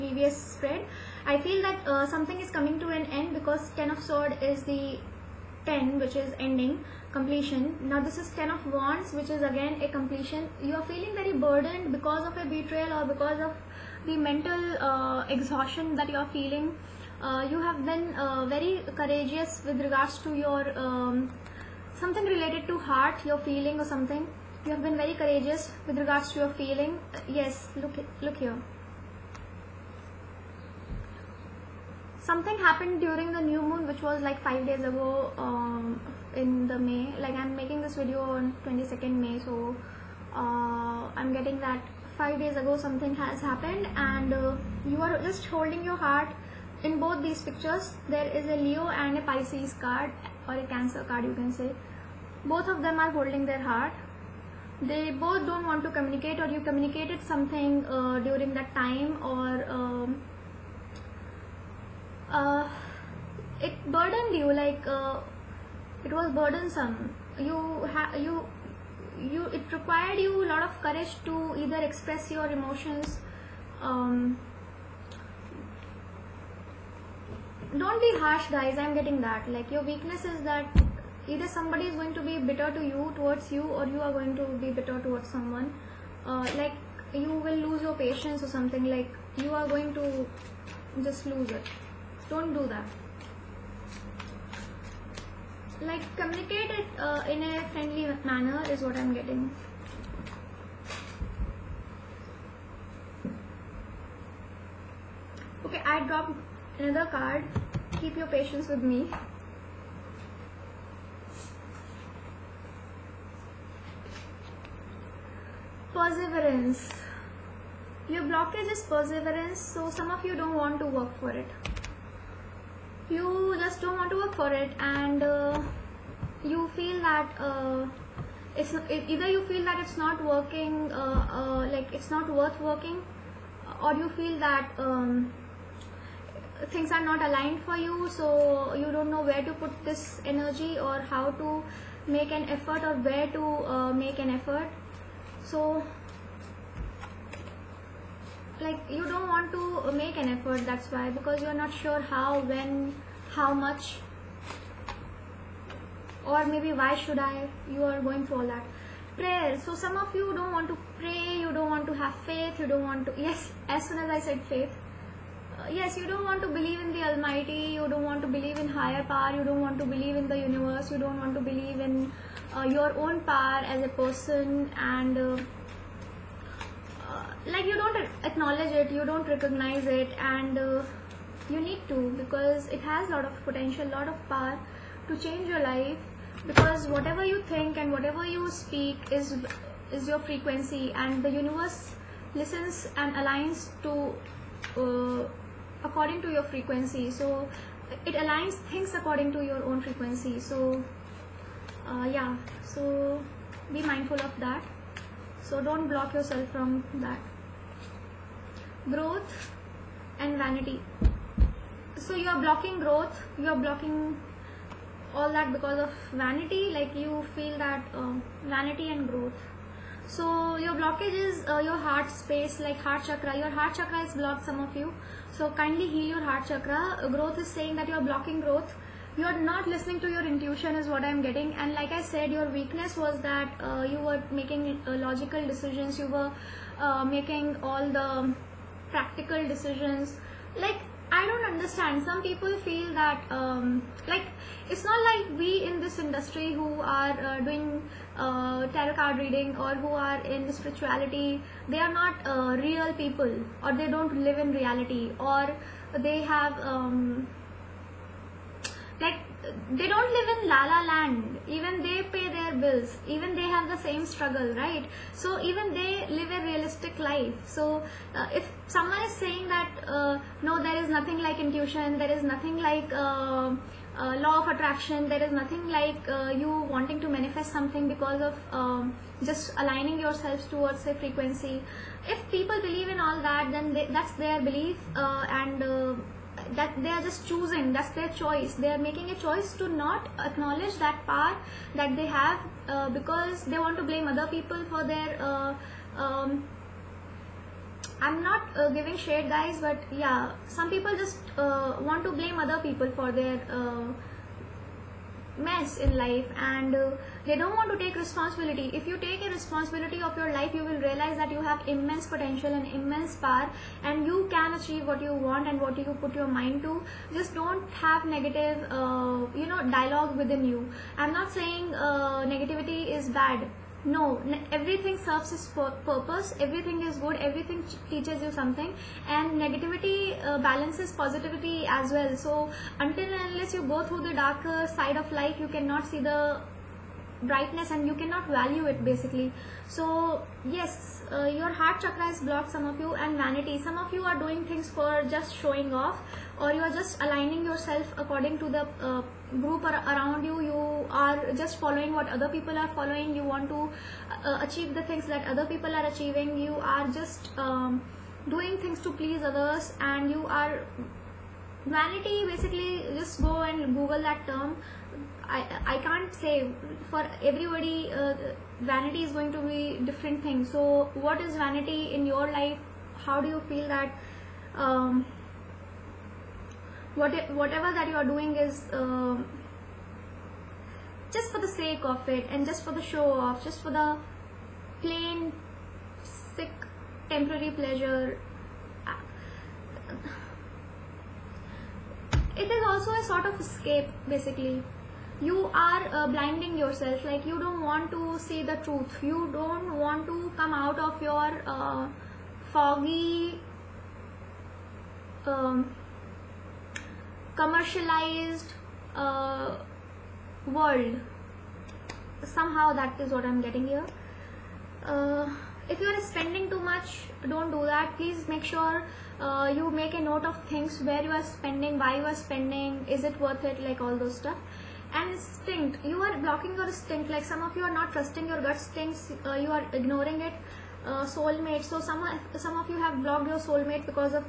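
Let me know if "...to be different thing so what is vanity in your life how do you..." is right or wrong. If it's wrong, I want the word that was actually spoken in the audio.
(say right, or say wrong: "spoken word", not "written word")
right.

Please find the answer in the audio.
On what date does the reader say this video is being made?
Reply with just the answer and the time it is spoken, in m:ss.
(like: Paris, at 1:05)
22nd May, at 0:38.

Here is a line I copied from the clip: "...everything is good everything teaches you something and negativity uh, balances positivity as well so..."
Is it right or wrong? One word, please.
right.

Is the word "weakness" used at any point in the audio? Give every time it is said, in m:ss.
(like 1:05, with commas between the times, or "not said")
1:19, 3:52.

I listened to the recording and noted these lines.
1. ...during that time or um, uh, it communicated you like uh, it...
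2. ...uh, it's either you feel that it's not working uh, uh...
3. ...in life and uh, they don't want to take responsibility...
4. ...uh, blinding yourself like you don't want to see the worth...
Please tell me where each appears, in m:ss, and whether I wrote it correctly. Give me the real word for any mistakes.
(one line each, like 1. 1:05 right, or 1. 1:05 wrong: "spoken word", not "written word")
1. 0:58 wrong: "burdened", not "communicated"
2. 2:07 right
3. 5:05 right
4. 6:35 wrong: "truth", not "worth".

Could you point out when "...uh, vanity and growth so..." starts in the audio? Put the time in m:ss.
3:37.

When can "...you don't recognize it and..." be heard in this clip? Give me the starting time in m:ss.
2:58.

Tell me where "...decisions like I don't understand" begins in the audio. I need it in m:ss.
3:59.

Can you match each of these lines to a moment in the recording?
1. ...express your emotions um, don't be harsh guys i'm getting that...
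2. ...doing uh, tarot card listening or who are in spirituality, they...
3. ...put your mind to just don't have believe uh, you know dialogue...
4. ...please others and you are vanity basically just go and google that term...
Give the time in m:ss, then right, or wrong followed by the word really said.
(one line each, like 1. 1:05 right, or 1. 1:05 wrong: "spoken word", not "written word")
1. 1:11 right
2. 4:07 wrong: "reading", not "listening"
3. 5:16 wrong: "negative", not "believe"
4. 5:58 right.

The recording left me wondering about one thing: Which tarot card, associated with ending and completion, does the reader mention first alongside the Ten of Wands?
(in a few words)
10 of Swords.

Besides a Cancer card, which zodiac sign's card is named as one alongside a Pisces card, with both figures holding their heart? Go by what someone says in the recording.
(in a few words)
Leo.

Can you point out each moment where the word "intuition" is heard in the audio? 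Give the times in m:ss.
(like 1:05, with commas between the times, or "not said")
3:50, 4:31.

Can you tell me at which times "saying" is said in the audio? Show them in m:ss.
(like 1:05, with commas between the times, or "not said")
3:47, 4:29, 5:21.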